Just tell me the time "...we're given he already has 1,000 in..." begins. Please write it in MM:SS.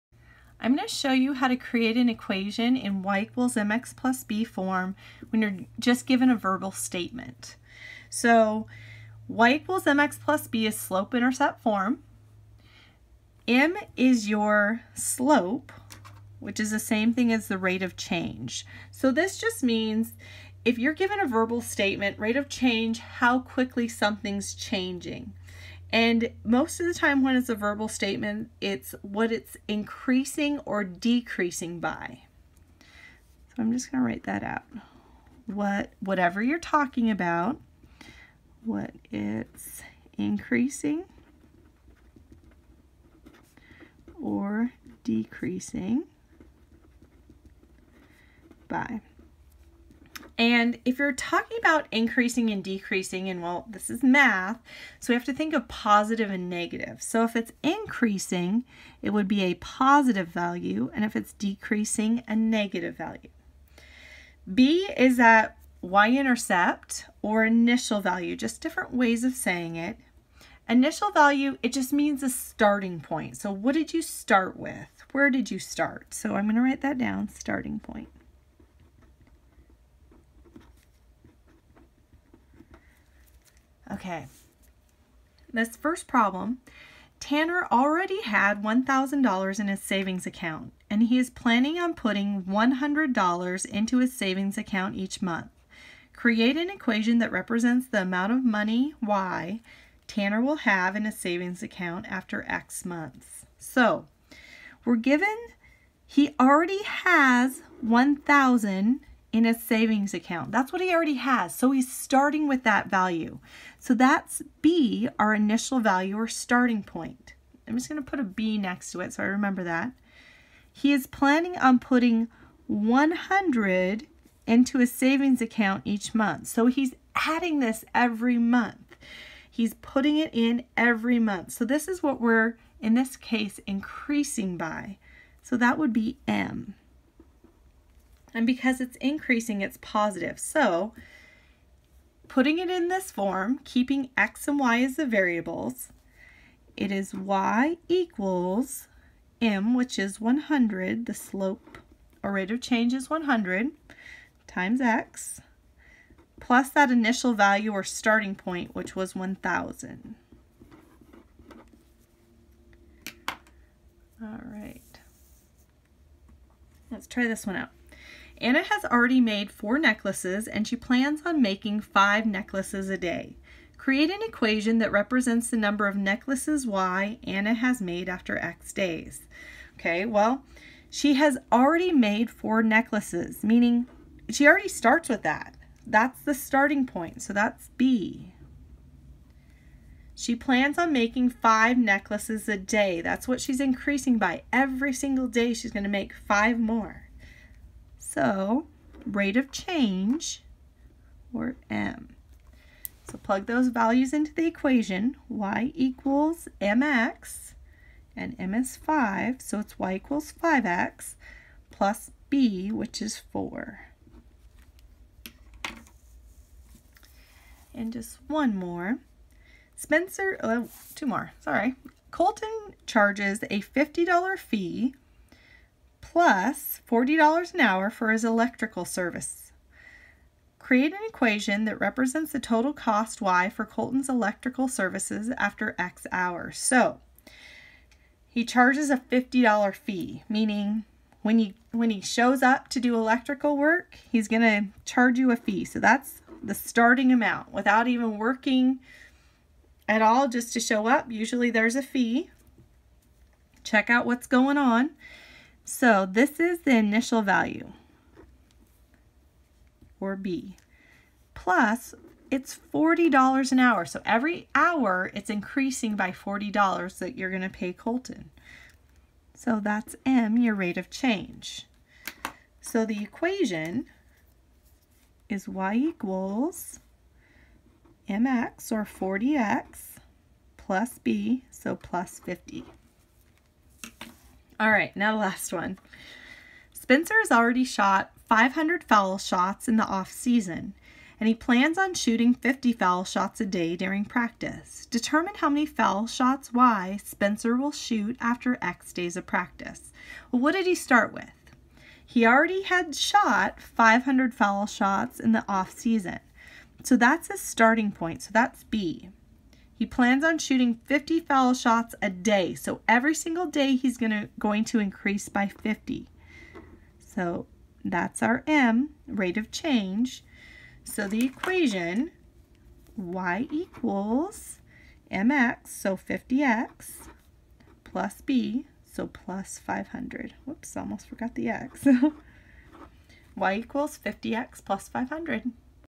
01:44.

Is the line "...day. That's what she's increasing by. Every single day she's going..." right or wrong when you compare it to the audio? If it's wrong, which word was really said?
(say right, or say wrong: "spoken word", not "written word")
right.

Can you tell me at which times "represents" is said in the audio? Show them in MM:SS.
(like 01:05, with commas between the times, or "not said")
01:37, 02:54, 03:51.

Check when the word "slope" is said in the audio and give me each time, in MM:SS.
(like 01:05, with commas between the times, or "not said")
00:10, 00:14, 02:31.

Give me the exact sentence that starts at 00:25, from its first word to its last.
And most of the time when it's a verbal statement, it's what it's increasing or decreasing by.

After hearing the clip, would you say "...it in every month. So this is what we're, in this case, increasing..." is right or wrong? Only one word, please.
right.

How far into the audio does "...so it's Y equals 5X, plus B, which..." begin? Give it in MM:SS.
03:29.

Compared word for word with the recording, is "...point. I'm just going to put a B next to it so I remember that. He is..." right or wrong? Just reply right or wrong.
right.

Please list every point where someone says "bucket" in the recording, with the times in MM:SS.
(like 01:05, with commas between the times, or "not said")
not said.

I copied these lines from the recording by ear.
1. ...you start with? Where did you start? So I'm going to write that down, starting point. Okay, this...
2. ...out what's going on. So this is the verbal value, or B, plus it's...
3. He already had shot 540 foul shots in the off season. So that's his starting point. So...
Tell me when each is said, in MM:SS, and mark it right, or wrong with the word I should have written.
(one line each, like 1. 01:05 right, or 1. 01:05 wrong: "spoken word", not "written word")
1. 01:13 right
2. 04:13 wrong: "initial", not "verbal"
3. 05:02 wrong: "500", not "540".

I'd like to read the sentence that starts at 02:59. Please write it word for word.
Okay, well, she has already made four necklaces, meaning she already starts with that.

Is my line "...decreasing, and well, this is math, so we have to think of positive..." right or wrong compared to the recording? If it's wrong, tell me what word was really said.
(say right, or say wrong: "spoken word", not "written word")
right.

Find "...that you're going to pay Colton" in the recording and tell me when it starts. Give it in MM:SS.
04:26.